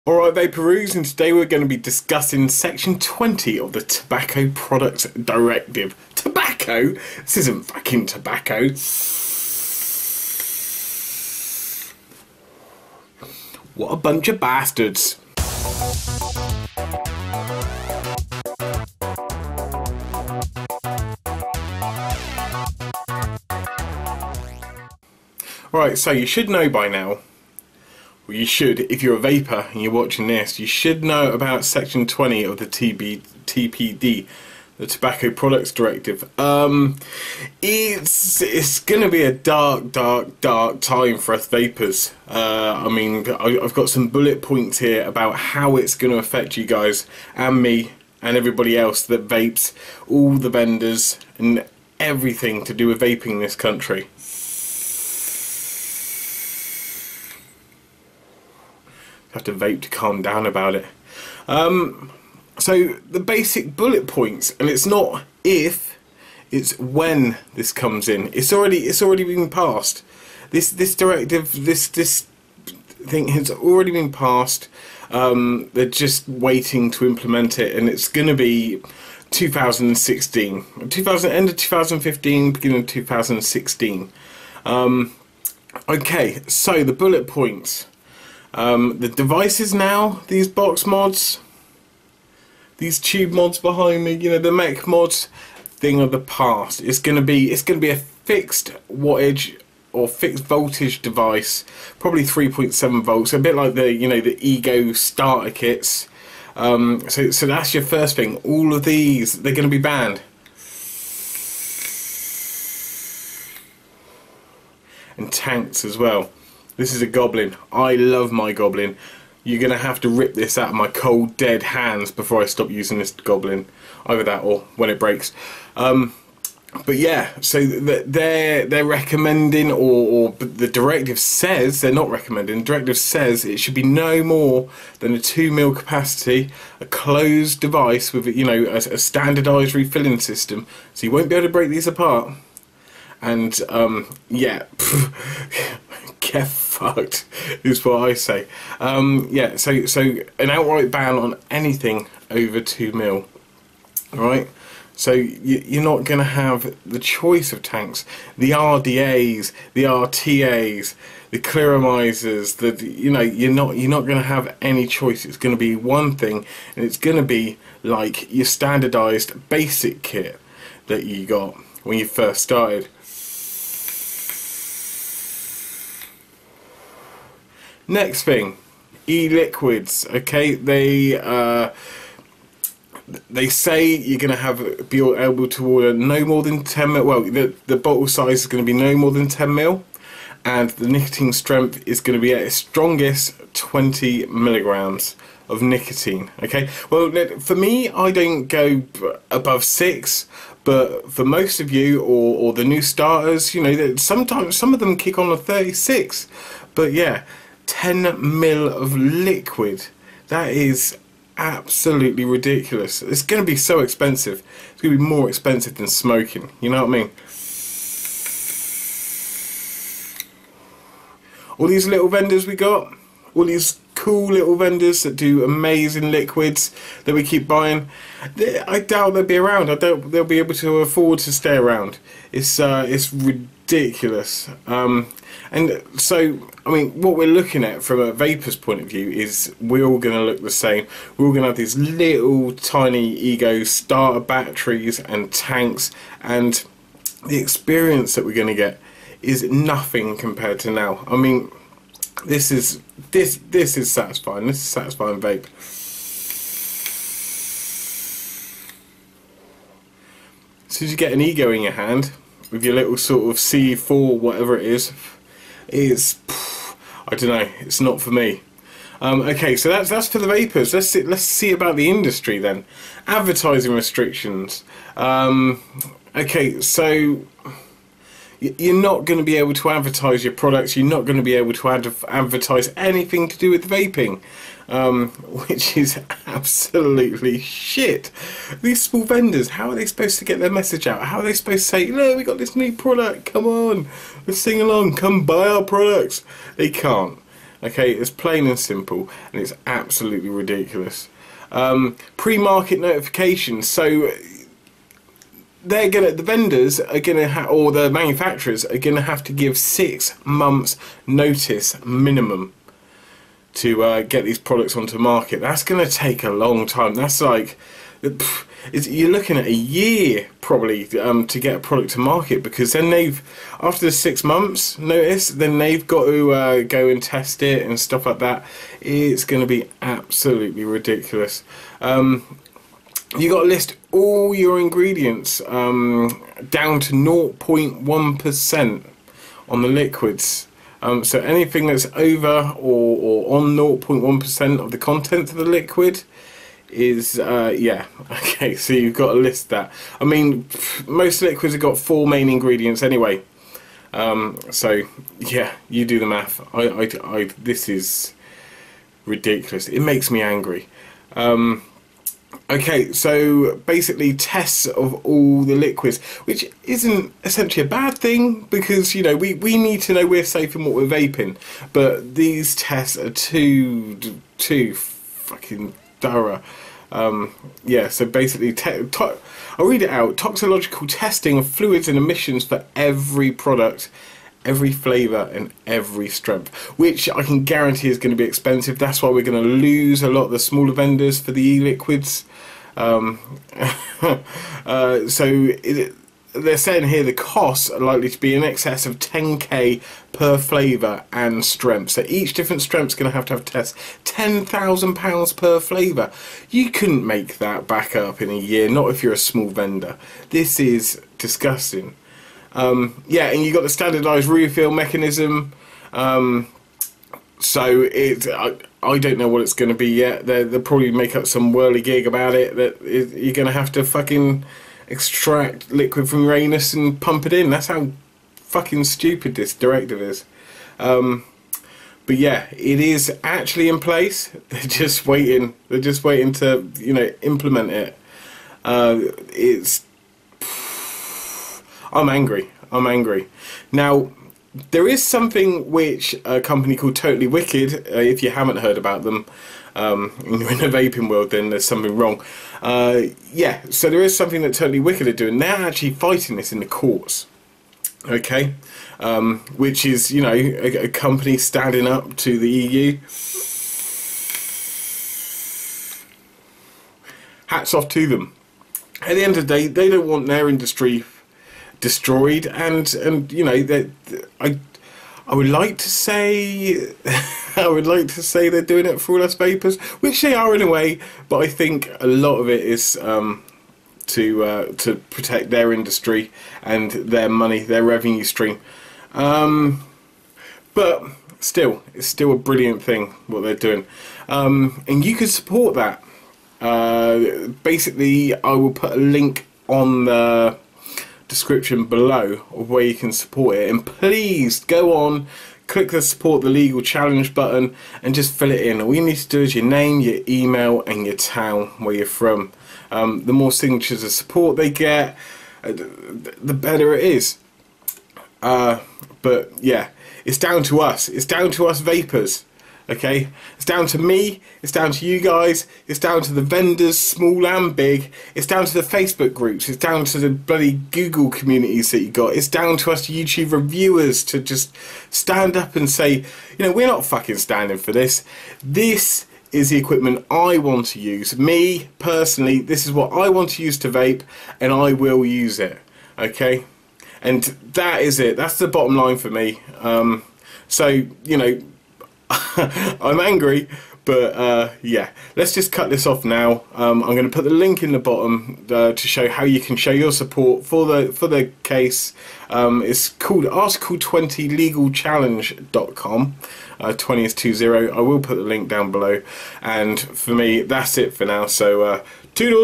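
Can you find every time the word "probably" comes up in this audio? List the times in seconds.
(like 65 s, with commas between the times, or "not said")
101 s, 320 s, 420 s.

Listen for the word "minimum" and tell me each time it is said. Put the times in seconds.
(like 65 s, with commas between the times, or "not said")
311 s.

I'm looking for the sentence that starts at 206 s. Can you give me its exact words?
But yeah, 10 mil of liquid.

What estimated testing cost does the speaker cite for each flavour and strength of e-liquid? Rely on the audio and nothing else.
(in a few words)
£10,000.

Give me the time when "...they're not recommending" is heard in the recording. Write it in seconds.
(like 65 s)
131 s.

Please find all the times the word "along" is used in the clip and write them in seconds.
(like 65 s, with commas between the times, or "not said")
294 s.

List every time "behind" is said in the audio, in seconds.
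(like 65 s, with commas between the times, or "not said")
93 s.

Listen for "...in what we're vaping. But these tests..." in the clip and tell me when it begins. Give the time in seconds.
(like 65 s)
370 s.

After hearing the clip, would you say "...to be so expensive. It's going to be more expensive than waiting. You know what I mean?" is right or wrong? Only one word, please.
wrong.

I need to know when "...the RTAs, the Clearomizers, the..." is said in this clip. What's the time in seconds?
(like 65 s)
159 s.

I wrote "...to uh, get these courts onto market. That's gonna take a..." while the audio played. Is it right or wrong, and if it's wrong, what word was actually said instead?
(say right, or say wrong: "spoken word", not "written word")
wrong: "products", not "courts".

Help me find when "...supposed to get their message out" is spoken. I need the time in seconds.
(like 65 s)
289 s.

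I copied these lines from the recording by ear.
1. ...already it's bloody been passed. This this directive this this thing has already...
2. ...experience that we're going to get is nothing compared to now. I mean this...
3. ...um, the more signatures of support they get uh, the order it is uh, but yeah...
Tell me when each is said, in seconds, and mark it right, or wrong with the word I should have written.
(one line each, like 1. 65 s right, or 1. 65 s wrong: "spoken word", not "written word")
1. 68 s wrong: "already", not "bloody"
2. 247 s right
3. 512 s wrong: "better", not "order".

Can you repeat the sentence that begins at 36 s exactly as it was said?
Um, it's it's going to be a dark, dark, dark time for us vapers.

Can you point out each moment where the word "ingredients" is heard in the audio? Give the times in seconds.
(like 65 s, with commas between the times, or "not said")
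334 s, 352 s.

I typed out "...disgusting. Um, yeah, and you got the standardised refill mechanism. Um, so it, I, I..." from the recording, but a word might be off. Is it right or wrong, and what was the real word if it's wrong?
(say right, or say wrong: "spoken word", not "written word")
right.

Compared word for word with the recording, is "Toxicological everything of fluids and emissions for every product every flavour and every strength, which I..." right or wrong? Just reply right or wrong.
wrong.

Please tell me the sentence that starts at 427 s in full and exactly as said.
That's how fucking stupid this directive is.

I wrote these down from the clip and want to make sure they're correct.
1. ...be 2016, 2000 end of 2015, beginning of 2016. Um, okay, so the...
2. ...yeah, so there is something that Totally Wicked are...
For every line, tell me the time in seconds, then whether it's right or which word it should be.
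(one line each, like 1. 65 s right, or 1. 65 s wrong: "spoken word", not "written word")
1. 78 s right
2. 453 s right.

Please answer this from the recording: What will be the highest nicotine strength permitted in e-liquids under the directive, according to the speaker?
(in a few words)
20 milligrams.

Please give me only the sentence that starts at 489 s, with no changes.
Um, but still, it's still a brilliant thing what they're doing, um, and you can support that.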